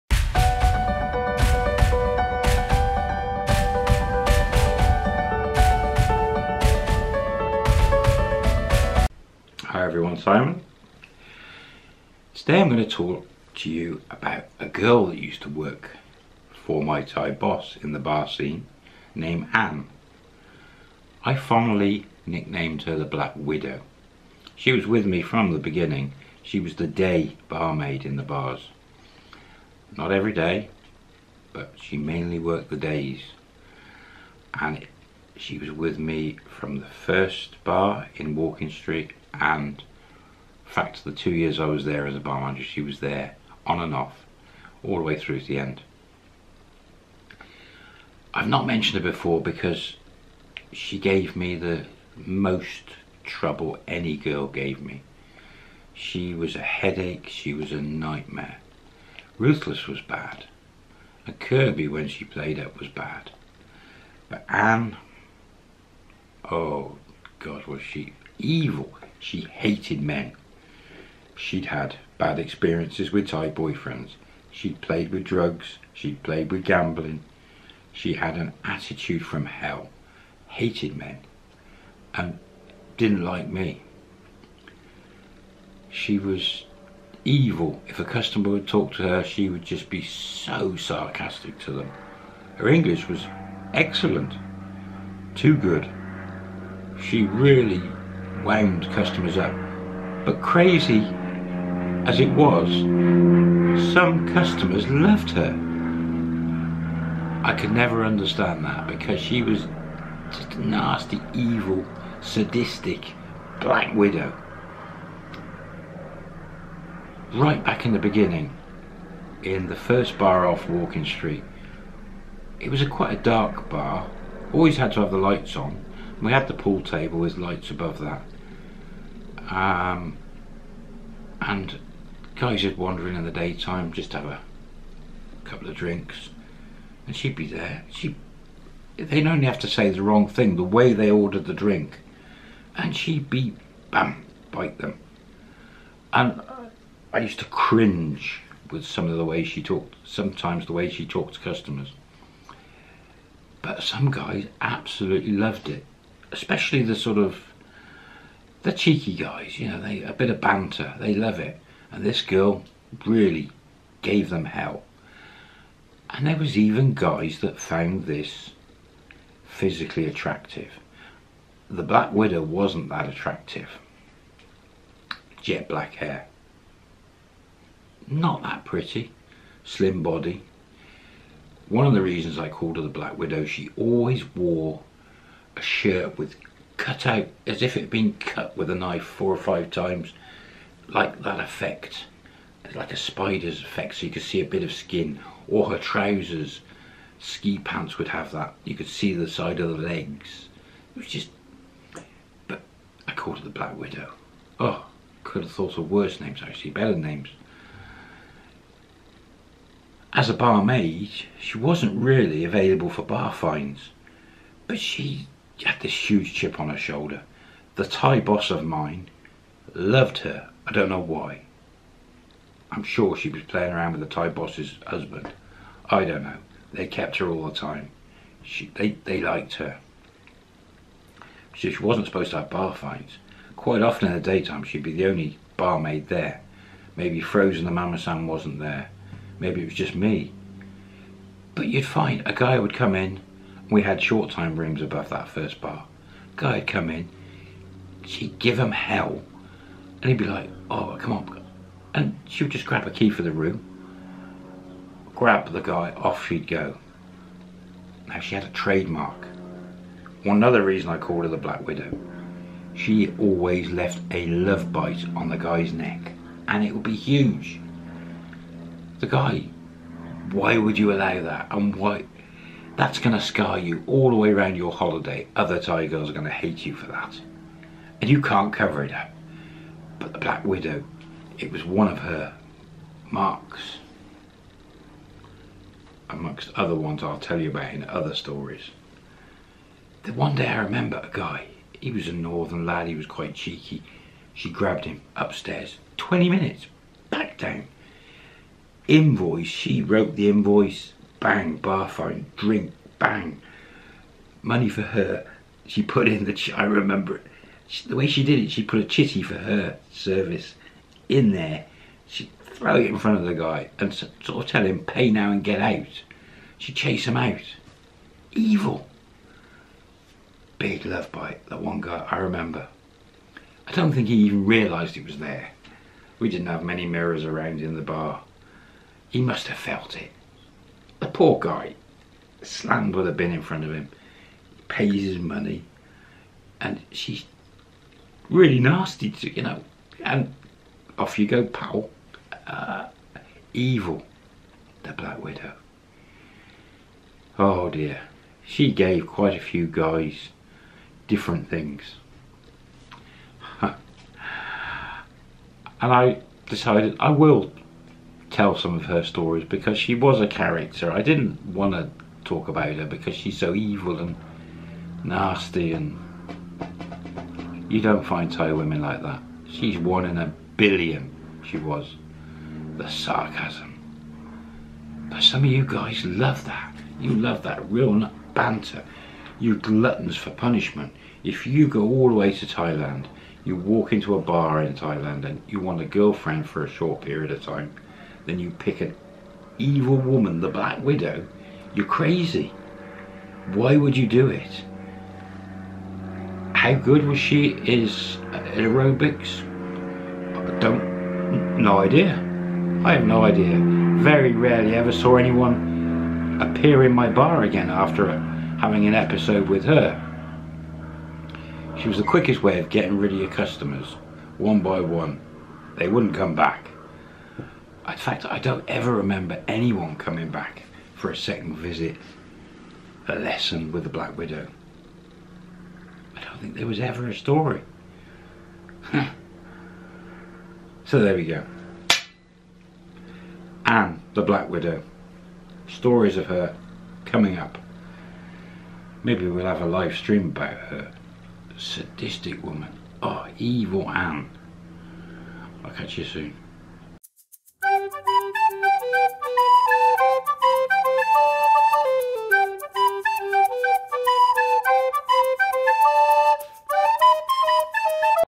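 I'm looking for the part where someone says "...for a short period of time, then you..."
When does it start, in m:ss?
6:26.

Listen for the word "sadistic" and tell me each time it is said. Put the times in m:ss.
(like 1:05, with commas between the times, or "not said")
1:52, 7:21.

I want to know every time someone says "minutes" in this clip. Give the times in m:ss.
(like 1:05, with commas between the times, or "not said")
4:56.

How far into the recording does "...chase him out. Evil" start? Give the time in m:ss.
5:16.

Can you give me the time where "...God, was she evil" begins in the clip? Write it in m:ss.
1:07.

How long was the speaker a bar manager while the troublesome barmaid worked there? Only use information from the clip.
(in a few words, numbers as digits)
2 years.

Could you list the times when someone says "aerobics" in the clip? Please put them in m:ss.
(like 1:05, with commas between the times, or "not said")
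6:38.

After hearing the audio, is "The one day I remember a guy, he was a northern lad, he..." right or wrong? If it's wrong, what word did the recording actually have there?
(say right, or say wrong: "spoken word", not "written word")
right.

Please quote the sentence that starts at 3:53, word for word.
Quite often in the daytime, she'd be the only barmaid there.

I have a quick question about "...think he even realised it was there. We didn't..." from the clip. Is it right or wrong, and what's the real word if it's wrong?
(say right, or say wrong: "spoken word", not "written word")
right.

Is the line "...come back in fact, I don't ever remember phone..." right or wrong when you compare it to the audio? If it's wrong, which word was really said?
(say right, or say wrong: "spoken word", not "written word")
wrong: "anyone", not "phone".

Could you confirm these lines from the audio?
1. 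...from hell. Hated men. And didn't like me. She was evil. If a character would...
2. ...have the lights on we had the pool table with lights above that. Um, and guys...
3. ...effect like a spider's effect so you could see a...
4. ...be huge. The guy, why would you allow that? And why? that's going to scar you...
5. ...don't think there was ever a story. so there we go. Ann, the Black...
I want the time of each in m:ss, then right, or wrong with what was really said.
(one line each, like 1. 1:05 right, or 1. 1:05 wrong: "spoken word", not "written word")
1. 1:19 wrong: "customer", not "character"
2. 2:05 right
3. 3:11 right
4. 4:26 right
5. 7:06 right.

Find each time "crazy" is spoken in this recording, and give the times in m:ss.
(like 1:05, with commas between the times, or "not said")
1:40, 6:31.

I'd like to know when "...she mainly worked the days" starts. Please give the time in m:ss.
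0:31.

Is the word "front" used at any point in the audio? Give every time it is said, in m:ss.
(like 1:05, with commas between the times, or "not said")
5:12, 5:33.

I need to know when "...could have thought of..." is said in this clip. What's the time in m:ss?
3:25.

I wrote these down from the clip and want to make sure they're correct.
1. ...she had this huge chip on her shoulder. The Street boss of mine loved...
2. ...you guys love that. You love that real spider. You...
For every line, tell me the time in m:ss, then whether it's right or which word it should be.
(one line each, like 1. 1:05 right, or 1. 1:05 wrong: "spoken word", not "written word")
1. 3:34 wrong: "Thai", not "Street"
2. 6:15 wrong: "banter", not "spider".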